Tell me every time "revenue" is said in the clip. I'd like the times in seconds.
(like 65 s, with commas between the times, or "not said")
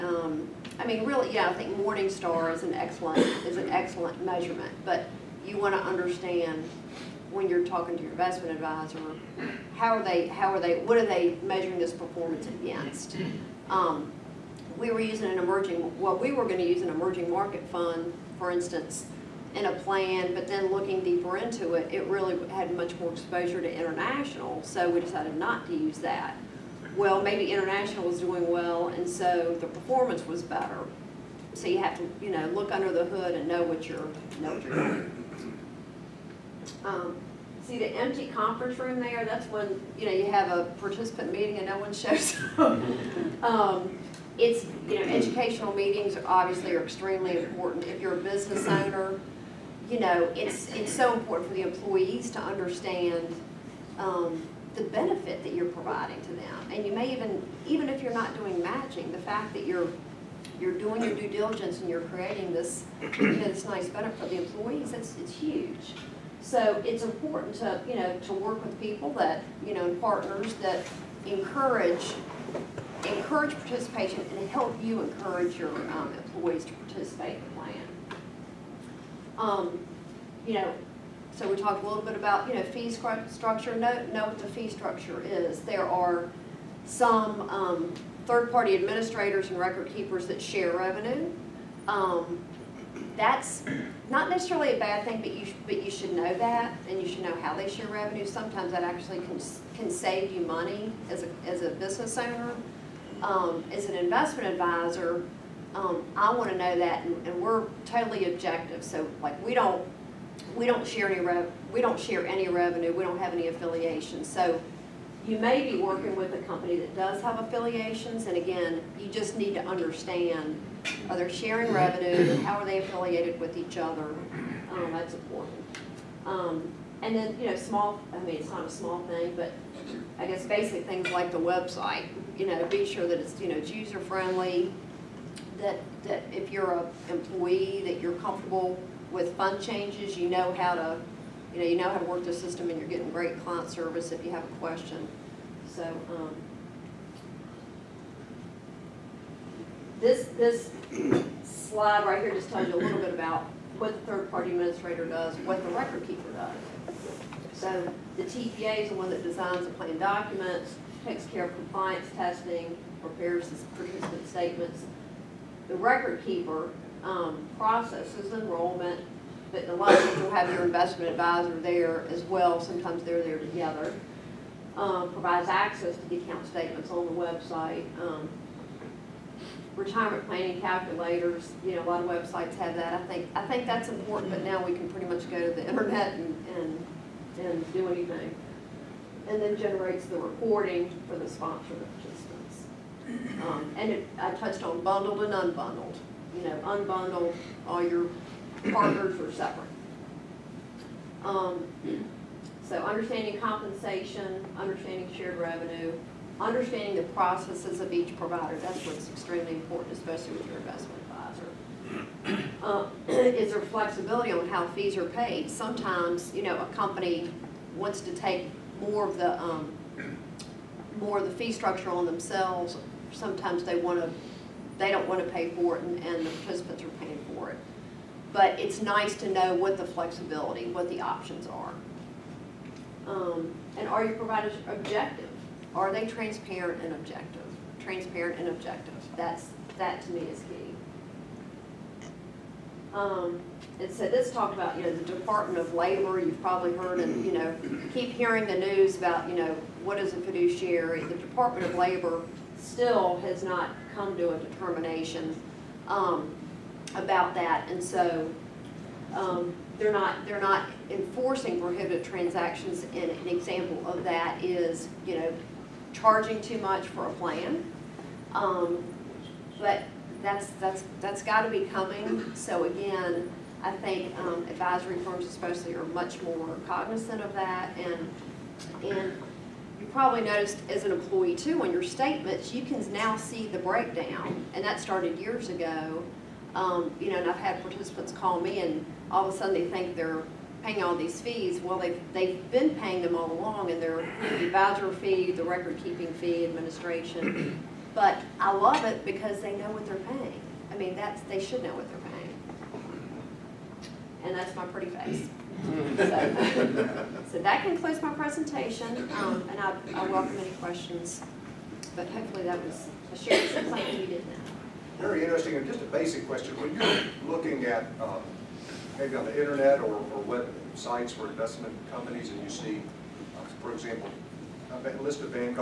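90 s, 97 s, 112 s, 121 s, 205 s.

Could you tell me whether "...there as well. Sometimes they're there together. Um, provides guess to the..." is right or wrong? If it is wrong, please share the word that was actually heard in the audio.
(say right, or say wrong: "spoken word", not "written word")
wrong: "access", not "guess".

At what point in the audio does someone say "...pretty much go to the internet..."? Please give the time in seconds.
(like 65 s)
184 s.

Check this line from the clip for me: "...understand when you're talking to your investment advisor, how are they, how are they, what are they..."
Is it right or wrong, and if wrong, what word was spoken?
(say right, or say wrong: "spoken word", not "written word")
right.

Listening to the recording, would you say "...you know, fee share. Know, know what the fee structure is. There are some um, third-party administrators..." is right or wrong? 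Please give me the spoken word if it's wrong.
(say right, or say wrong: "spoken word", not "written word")
wrong: "structure", not "share".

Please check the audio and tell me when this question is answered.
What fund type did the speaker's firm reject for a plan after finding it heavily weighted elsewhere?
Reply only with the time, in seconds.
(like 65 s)
16 s.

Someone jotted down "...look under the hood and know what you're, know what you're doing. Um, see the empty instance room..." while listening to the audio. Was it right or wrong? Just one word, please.
wrong.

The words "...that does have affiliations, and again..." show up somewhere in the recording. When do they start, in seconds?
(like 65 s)
116 s.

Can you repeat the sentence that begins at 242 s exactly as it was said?
Um, and so this talk about you know the Department of Labor.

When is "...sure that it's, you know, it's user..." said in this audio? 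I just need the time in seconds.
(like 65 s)
132 s.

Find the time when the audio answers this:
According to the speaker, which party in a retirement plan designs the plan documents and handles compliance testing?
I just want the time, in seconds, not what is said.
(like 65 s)
158 s.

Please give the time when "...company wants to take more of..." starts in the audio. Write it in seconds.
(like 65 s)
216 s.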